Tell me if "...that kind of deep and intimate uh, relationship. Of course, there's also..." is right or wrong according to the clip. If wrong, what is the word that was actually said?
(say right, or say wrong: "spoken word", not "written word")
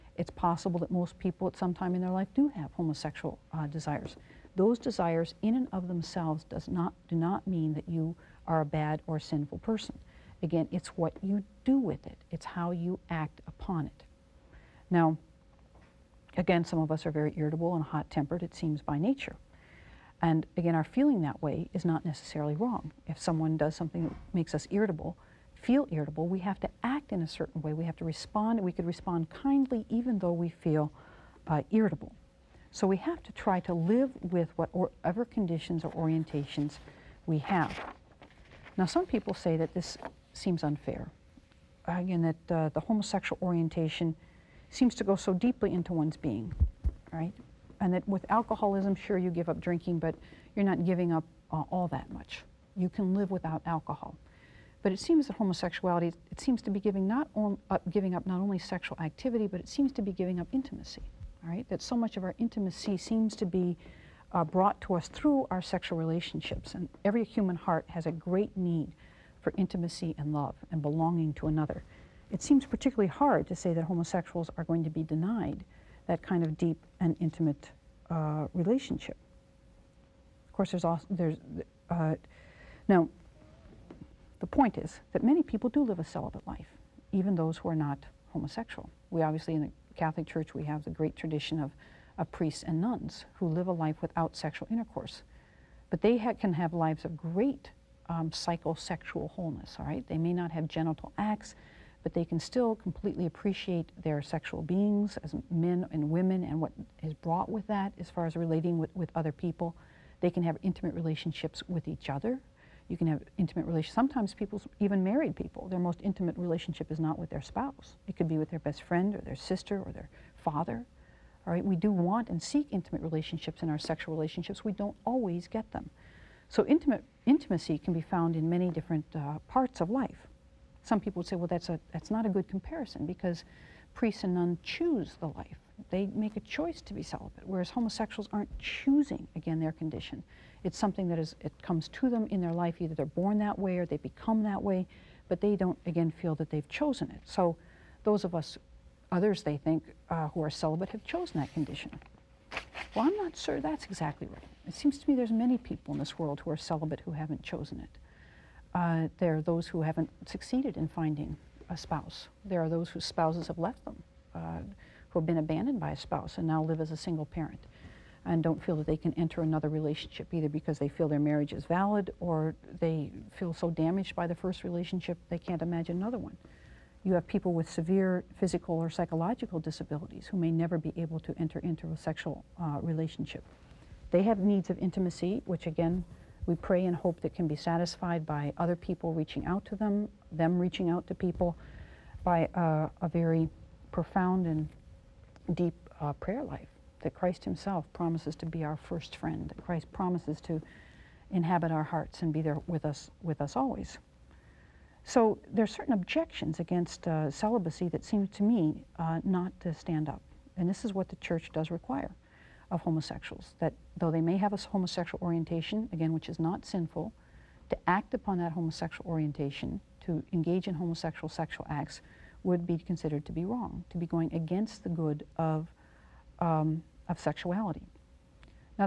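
right.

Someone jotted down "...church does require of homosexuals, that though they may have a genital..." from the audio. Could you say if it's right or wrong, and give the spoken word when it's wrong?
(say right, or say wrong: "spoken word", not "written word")
wrong: "homosexual", not "genital".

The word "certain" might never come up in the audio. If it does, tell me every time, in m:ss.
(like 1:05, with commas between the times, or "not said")
0:27, 3:25.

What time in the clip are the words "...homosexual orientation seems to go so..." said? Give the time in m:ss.
0:42.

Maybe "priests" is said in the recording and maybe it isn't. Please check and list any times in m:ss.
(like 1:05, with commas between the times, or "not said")
1:32, 2:13.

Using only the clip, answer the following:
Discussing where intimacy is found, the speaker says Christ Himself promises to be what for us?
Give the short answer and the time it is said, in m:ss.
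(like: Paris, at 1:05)
our first friend, at 3:18.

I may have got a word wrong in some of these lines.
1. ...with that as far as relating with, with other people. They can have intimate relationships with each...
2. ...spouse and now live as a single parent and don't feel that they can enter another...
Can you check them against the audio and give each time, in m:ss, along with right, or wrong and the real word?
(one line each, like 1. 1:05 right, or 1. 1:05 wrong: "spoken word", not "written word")
1. 1:47 right
2. 2:45 right.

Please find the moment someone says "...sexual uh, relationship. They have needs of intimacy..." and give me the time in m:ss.
3:01.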